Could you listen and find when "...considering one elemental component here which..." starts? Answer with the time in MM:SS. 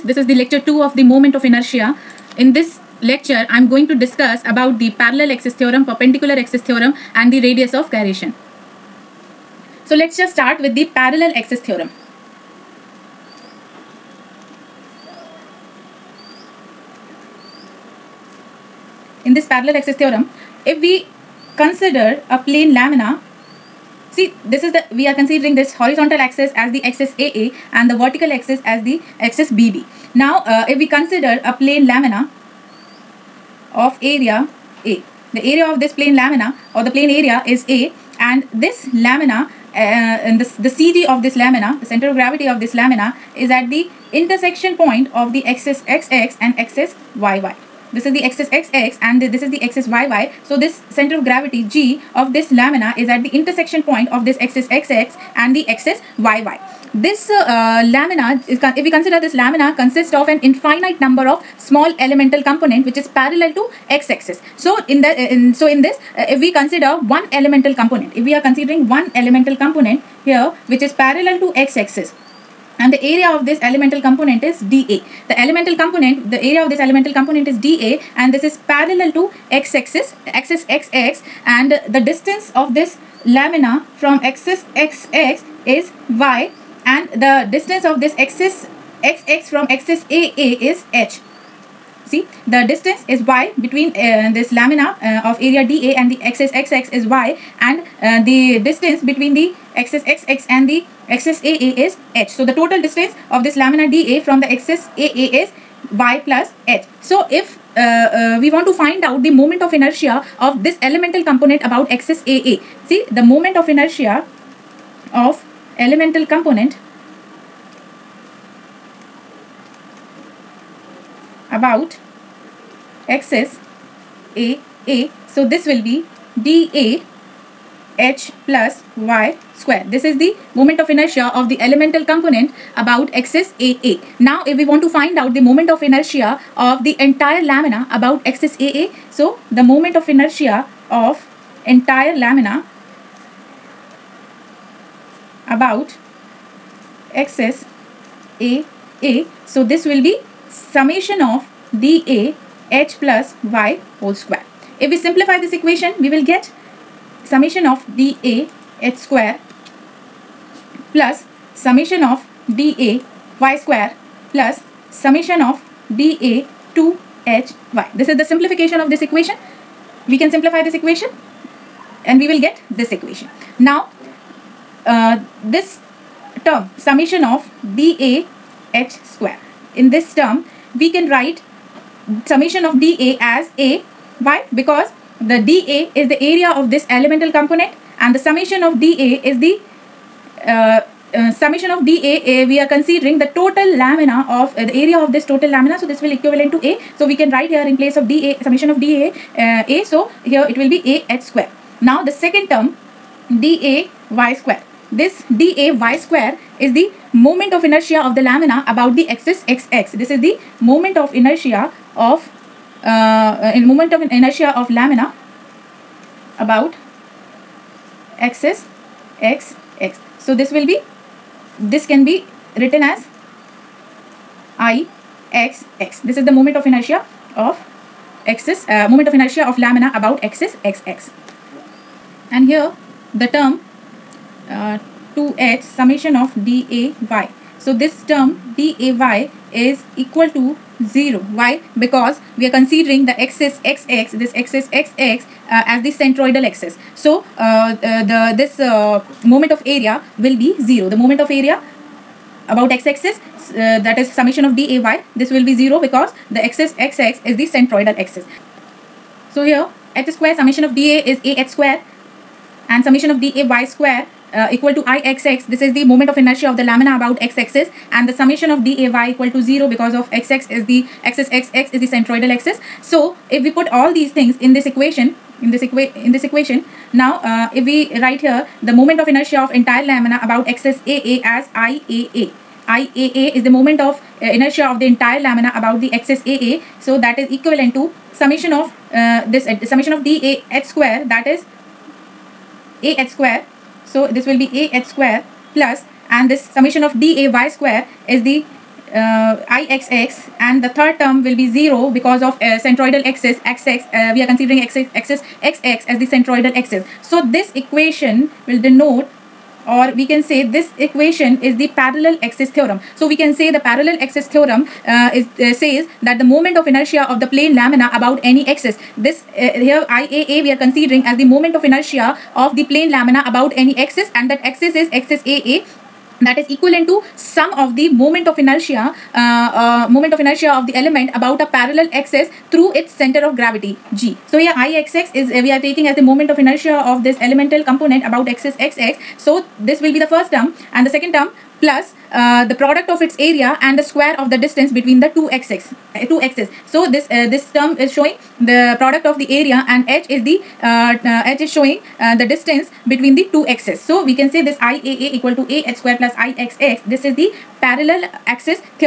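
01:08.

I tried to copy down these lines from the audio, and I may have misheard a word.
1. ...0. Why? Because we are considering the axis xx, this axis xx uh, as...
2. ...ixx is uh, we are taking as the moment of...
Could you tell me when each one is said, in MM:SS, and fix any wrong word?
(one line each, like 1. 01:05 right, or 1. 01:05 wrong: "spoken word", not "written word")
1. 04:00 right
2. 05:34 right.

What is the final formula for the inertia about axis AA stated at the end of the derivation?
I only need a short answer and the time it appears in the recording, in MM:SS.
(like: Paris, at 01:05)
IAA = Ah² + IXX, at 05:54.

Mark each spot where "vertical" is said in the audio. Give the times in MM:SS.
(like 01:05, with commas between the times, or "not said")
00:27.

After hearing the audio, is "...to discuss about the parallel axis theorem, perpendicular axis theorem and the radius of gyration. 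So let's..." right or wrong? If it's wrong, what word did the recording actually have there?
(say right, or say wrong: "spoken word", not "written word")
right.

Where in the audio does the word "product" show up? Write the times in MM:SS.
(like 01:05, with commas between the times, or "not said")
05:42, 05:48.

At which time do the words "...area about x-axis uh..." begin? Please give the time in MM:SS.
04:11.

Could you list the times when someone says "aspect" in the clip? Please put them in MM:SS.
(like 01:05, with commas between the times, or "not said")
not said.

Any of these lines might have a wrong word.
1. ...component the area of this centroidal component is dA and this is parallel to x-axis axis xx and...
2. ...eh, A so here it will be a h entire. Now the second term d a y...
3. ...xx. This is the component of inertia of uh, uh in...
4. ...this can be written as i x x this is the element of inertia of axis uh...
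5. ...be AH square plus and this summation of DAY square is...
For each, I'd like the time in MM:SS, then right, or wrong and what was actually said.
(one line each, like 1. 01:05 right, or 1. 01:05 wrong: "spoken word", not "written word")
1. 01:15 wrong: "elemental", not "centroidal"
2. 03:19 wrong: "square", not "entire"
3. 03:29 wrong: "moment", not "component"
4. 03:41 wrong: "moment", not "element"
5. 04:54 right.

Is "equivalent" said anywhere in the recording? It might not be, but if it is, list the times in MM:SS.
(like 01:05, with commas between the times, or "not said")
03:16, 04:47, 05:26.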